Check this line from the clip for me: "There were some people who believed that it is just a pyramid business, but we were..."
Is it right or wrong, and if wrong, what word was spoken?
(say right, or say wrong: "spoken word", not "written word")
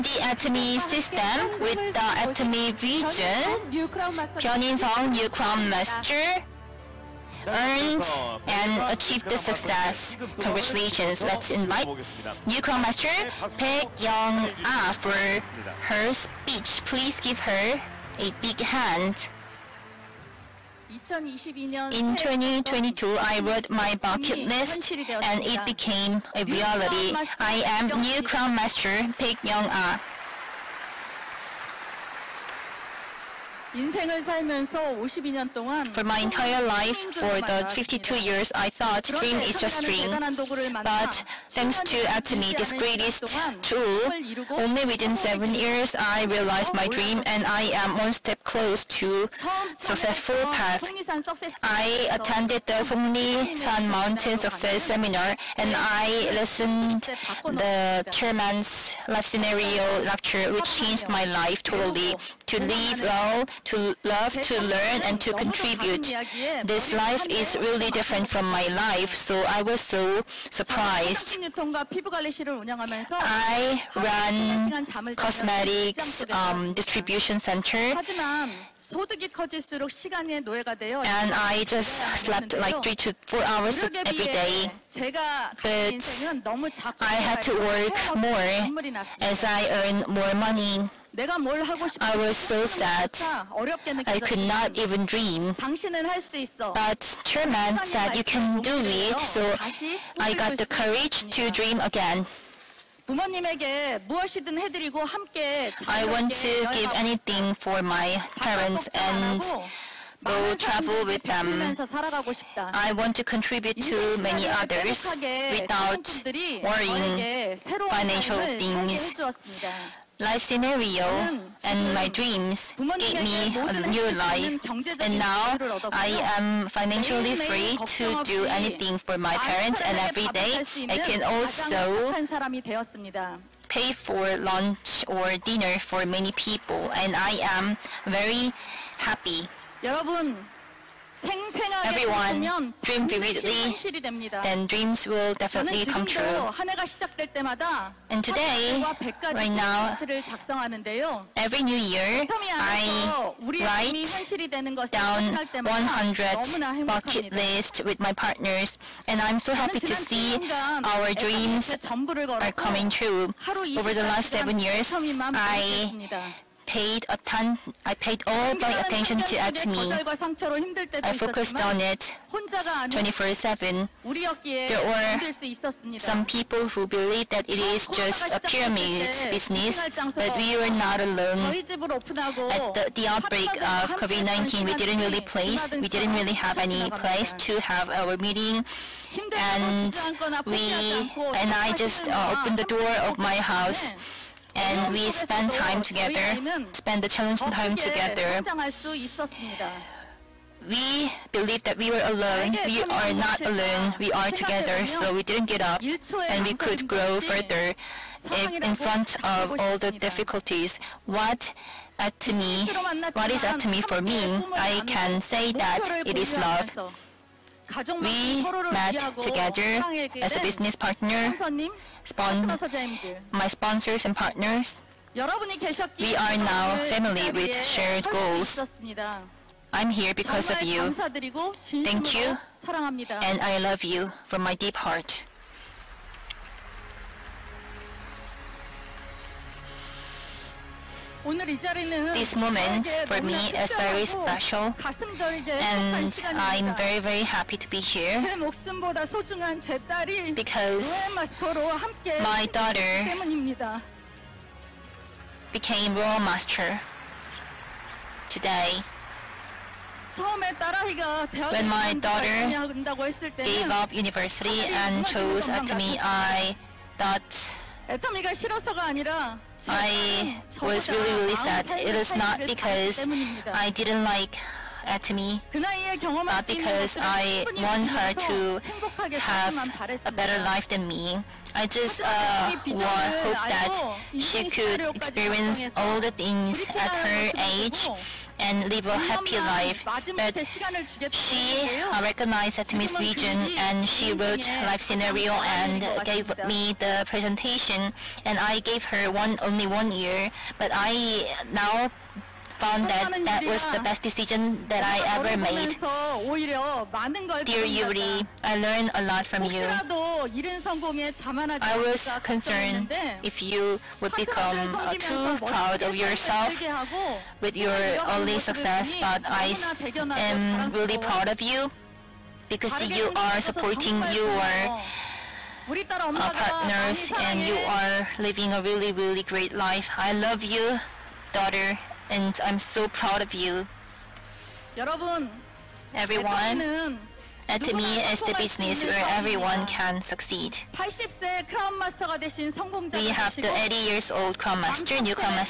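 right.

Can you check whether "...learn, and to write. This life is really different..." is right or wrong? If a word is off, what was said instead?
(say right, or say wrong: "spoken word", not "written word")
wrong: "contribute", not "write".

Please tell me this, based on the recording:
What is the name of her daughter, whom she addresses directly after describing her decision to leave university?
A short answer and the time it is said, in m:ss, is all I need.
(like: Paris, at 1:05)
Yuri, at 5:07.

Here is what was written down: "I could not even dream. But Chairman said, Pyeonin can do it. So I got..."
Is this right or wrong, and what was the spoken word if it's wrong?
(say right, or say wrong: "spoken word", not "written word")
wrong: "You", not "Pyeonin".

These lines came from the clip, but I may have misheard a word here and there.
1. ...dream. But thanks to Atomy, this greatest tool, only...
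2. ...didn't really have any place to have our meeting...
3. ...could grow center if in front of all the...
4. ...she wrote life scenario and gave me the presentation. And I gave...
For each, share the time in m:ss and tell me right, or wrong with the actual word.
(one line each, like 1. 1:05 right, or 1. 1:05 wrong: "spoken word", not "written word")
1. 0:39 right
2. 3:05 right
3. 3:26 wrong: "further", not "center"
4. 4:53 right.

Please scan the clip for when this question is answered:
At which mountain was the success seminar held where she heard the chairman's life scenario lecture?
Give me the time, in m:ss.
0:52.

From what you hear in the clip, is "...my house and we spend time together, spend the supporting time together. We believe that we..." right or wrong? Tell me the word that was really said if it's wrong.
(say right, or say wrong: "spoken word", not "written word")
wrong: "challenging", not "supporting".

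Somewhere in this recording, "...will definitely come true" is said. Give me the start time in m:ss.
2:25.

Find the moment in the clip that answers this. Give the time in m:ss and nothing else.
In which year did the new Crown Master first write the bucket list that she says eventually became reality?
0:22.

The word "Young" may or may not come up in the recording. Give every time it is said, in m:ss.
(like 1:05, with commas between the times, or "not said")
0:13, 0:29.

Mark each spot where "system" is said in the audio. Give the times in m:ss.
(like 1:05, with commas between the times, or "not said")
0:00.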